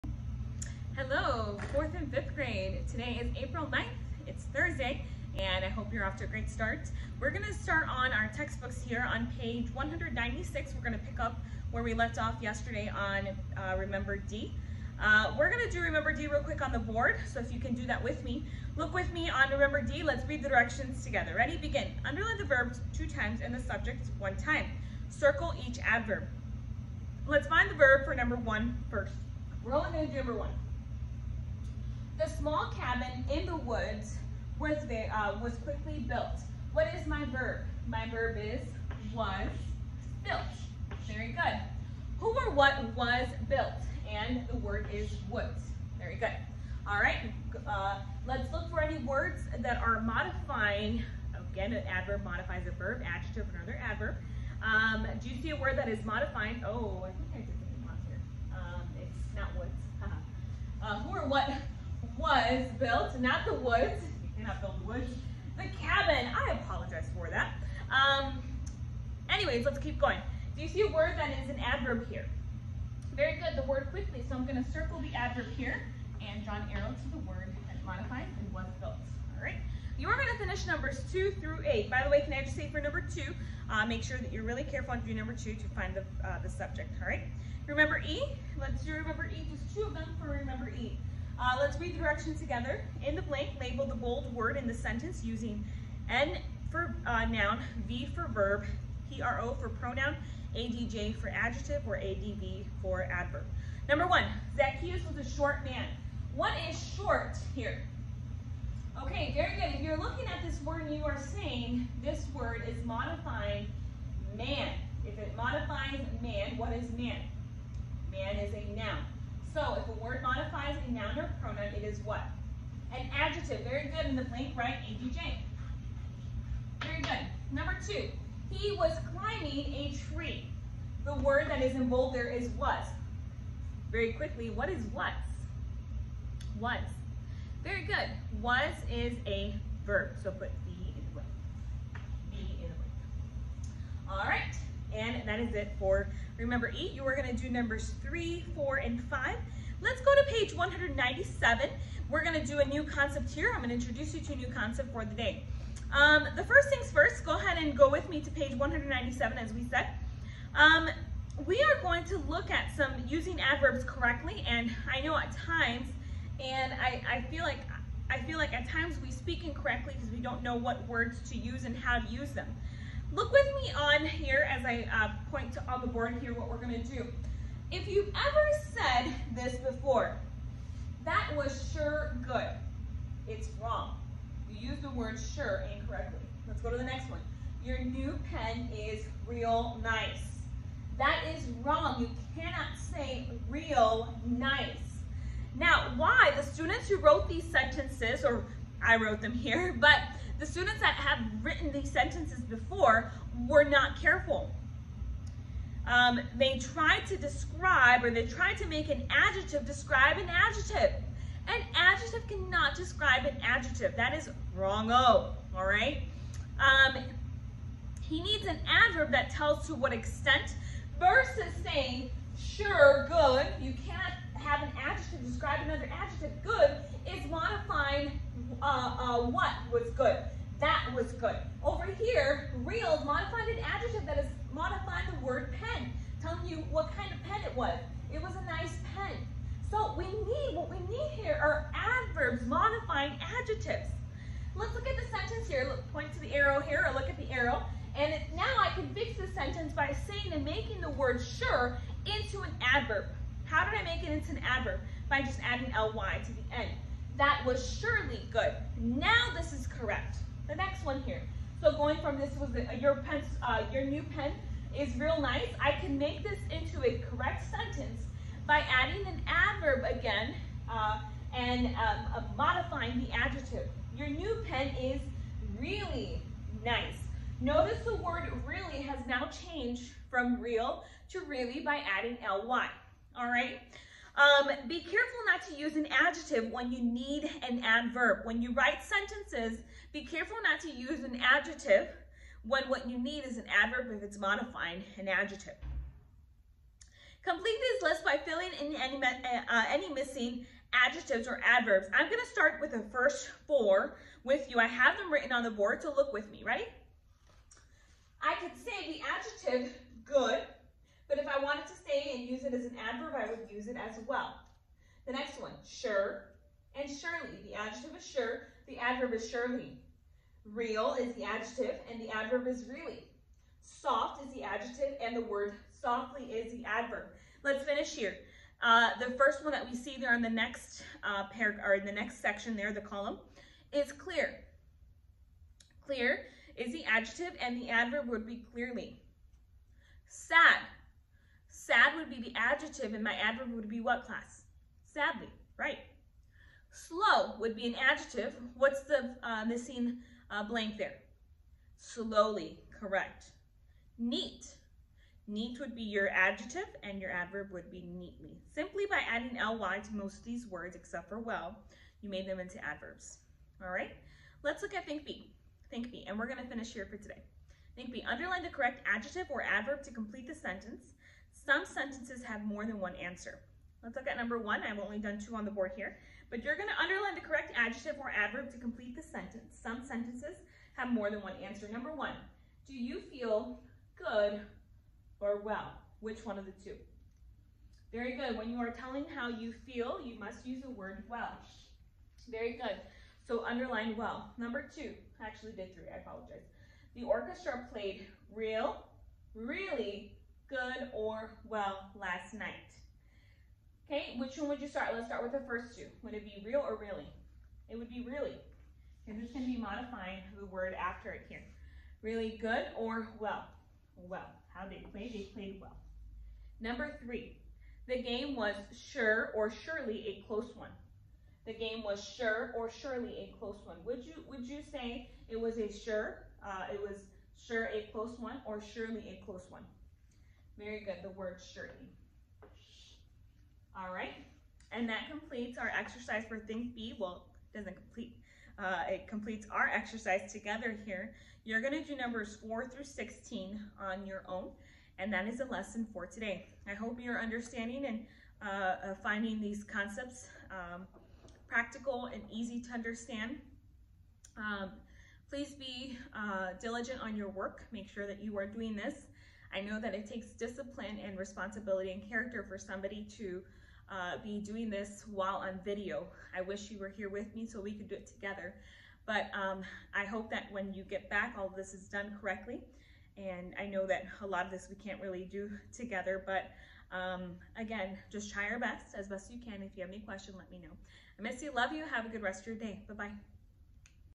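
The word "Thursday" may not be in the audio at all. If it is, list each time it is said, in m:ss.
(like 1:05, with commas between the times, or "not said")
0:04.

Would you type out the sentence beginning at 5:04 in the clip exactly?
I have them written on the board, so look with me, ready?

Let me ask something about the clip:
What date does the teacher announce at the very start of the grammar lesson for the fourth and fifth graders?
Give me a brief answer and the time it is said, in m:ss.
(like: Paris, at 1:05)
April 9th, at 0:03.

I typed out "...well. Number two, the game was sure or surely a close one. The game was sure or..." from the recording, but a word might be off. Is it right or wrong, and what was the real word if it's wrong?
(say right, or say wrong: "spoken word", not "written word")
wrong: "three", not "two".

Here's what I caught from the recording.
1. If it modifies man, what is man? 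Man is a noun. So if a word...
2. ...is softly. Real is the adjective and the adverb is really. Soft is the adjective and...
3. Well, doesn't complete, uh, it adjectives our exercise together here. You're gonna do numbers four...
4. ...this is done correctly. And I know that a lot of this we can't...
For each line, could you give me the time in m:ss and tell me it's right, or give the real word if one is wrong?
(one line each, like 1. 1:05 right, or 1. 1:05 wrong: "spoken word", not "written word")
1. 1:55 right
2. 5:19 wrong: "surely", not "softly"
3. 7:16 wrong: "completes", not "adjectives"
4. 7:51 right.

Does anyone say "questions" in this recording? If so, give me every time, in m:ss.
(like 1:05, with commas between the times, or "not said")
7:59.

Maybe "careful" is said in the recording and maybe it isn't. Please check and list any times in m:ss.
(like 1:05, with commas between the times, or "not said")
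1:24, 3:24, 4:44, 4:50.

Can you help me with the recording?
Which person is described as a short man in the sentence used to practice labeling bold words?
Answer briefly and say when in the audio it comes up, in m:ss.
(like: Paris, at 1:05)
Zacchaeus, at 1:44.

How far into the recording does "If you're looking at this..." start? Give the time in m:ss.
1:49.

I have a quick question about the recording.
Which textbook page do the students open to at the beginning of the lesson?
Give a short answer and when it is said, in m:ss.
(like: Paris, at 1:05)
196, at 0:09.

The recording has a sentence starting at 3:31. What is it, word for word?
An adjective cannot describe an adjective.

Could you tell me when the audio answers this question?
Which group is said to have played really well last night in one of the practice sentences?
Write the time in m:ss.
6:36.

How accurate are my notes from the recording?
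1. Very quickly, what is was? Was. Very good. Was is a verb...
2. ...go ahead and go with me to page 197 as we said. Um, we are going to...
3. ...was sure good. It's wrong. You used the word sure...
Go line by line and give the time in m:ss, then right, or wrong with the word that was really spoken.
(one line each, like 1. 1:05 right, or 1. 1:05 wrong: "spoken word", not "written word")
1. 2:13 right
2. 2:37 right
3. 3:01 right.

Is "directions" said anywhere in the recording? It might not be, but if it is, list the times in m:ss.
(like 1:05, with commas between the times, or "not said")
0:20, 1:31.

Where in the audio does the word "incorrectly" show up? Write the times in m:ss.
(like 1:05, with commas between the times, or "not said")
2:49, 3:05.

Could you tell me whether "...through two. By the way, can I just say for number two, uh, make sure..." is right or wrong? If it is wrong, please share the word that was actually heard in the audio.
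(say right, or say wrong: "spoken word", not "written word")
wrong: "eight", not "two".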